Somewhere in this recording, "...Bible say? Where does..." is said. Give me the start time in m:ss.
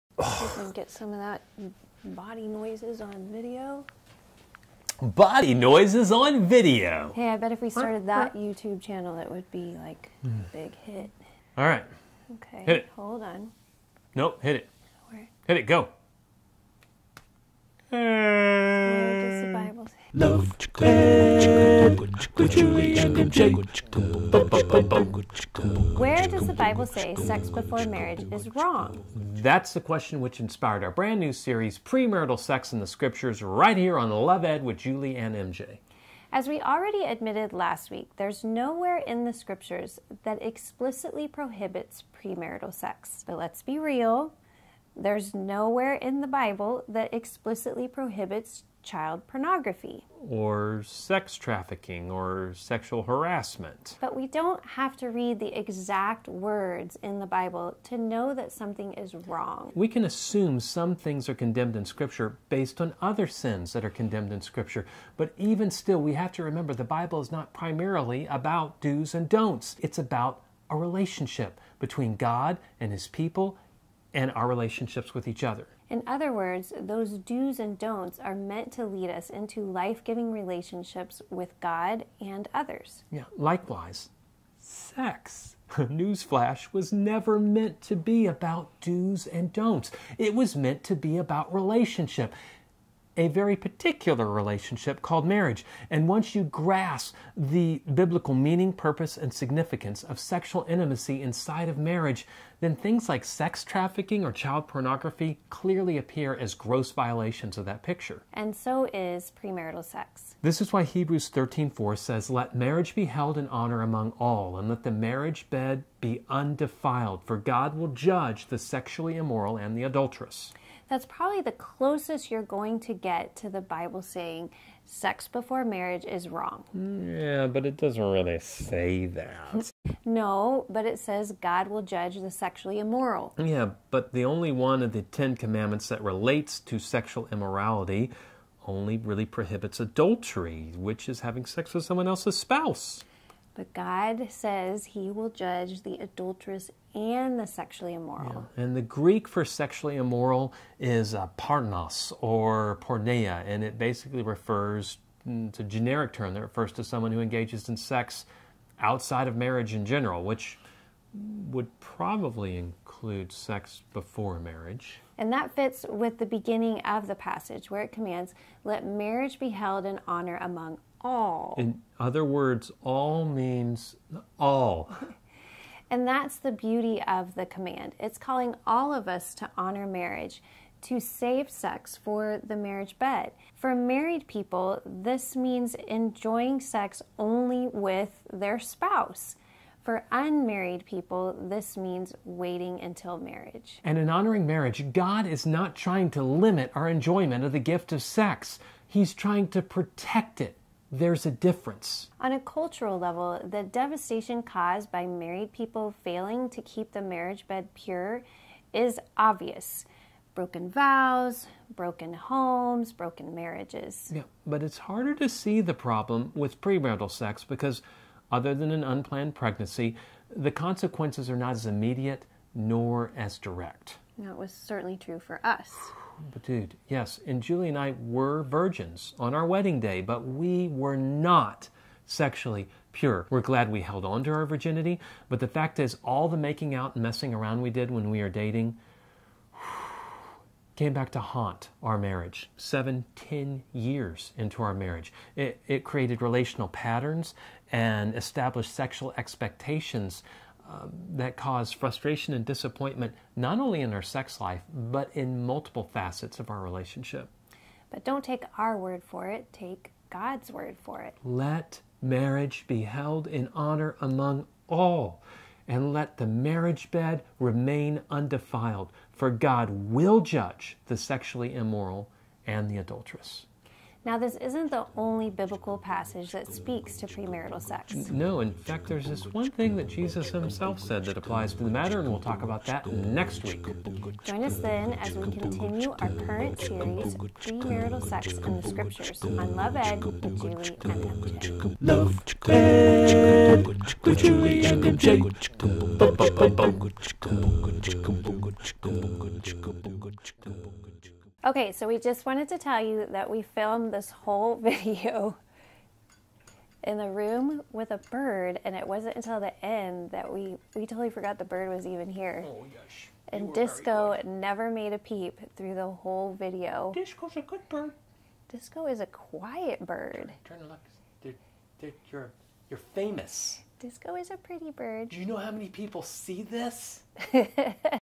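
0:19.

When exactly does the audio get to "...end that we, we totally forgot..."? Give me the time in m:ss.
5:09.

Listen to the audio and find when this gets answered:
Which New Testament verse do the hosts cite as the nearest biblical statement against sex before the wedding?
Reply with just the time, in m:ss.
1:50.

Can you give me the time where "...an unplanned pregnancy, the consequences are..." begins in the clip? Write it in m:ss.
3:38.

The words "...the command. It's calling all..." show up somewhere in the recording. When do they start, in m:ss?
2:57.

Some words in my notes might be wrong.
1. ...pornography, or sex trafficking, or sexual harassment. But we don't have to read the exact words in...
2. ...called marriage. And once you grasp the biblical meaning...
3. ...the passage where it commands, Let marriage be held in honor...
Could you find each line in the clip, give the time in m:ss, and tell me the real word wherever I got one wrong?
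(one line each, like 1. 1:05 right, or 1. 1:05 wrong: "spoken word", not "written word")
1. 0:49 right
2. 1:35 right
3. 2:47 right.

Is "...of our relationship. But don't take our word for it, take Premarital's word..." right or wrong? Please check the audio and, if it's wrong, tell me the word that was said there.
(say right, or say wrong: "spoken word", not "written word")
wrong: "God", not "Premarital".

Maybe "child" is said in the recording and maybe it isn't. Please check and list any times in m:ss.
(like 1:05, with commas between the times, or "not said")
0:48, 1:44.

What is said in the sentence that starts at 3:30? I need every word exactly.
Broken vows, broken homes, broken marriages.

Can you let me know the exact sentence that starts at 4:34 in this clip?
Now, this isn't the only biblical passage that speaks to premarital sex.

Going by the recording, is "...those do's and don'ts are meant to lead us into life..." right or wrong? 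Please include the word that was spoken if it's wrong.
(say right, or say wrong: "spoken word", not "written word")
right.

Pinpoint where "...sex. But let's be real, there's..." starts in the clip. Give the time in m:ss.
0:42.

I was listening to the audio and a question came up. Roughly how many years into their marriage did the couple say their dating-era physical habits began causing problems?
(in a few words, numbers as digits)
7 to 10 years.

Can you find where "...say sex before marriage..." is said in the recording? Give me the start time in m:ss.
0:26.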